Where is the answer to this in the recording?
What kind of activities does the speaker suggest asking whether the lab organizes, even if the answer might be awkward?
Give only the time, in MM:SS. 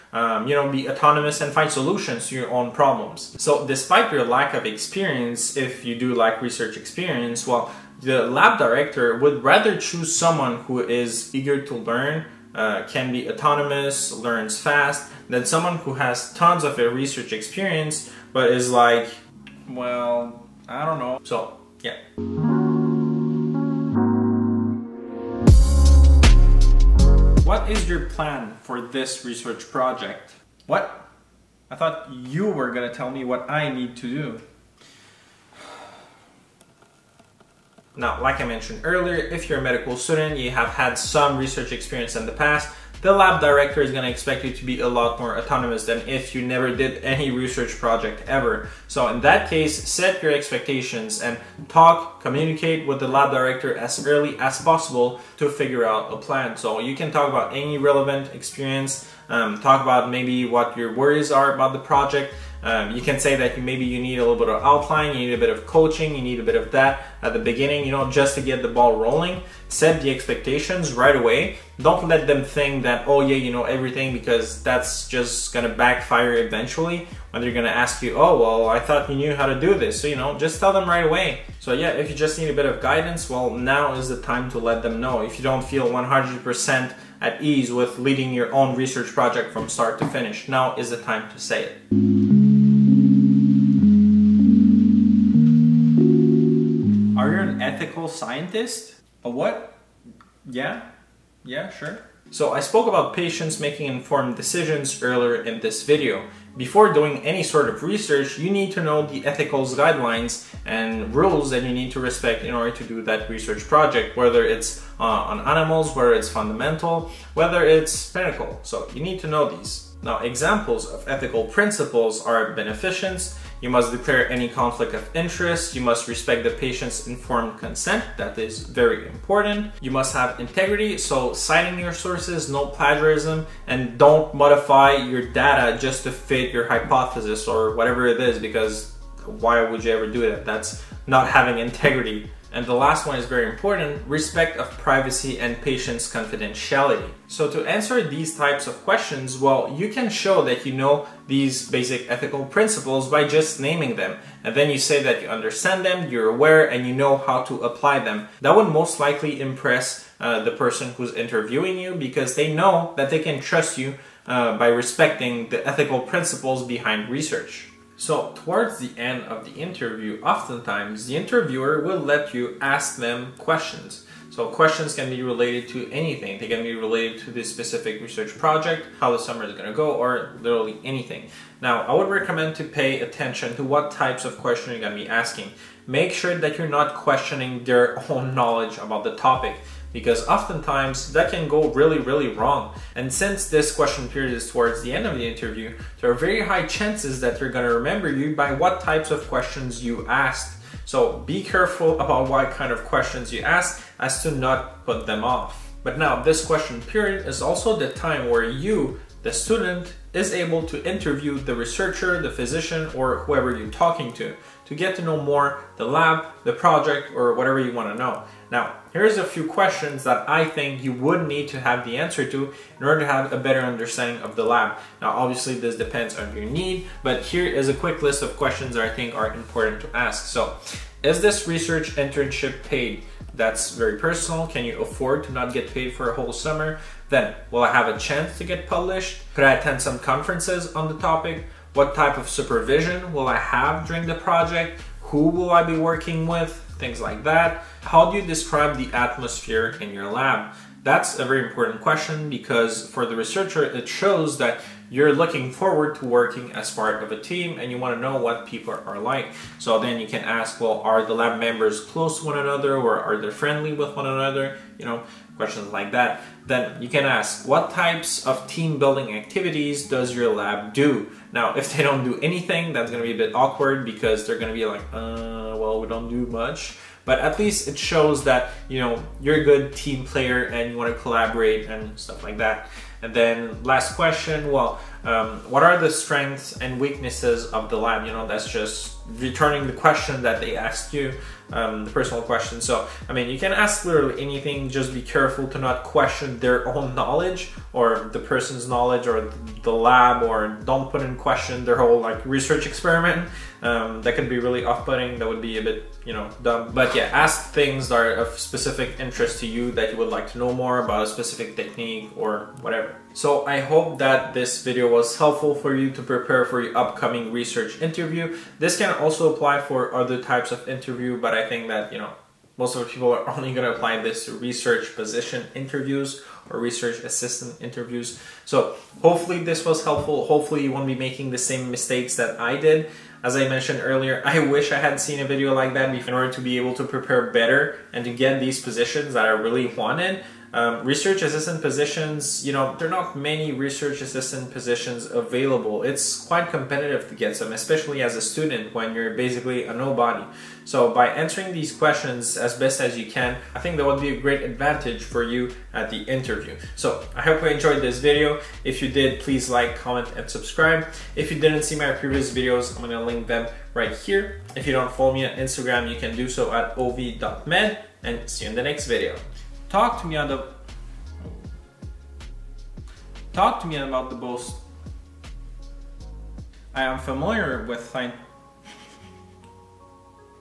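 04:28.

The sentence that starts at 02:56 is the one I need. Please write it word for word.
They can be related to this specific research project, how the summer is going to go, or literally anything.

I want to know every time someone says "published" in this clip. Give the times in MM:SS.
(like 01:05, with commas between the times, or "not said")
03:58.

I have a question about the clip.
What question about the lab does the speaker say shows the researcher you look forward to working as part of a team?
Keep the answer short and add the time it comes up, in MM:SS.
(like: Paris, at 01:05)
The atmosphere in your lab, at 04:07.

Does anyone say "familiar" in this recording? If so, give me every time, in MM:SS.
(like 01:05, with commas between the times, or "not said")
06:16.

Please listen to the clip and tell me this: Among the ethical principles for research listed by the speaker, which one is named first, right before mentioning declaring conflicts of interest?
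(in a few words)
Beneficence.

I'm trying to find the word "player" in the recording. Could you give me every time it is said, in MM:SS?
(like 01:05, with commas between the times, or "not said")
04:40.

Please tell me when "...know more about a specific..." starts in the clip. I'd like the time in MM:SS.
05:10.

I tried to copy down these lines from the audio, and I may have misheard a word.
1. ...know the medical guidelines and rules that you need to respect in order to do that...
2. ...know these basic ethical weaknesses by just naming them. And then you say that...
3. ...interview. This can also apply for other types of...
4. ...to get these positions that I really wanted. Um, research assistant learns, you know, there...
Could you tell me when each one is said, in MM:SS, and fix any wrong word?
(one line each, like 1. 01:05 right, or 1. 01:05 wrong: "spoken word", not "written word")
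1. 01:48 wrong: "ethical", not "medical"
2. 02:30 wrong: "principles", not "weaknesses"
3. 05:17 right
4. 05:38 wrong: "positions", not "learns".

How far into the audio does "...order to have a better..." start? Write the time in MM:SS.
03:42.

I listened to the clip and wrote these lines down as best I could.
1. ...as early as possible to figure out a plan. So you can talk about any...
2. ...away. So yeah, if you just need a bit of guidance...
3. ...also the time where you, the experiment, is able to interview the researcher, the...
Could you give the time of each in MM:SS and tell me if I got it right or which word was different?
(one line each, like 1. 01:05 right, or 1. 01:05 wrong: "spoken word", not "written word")
1. 00:53 right
2. 01:21 right
3. 03:27 wrong: "student", not "experiment".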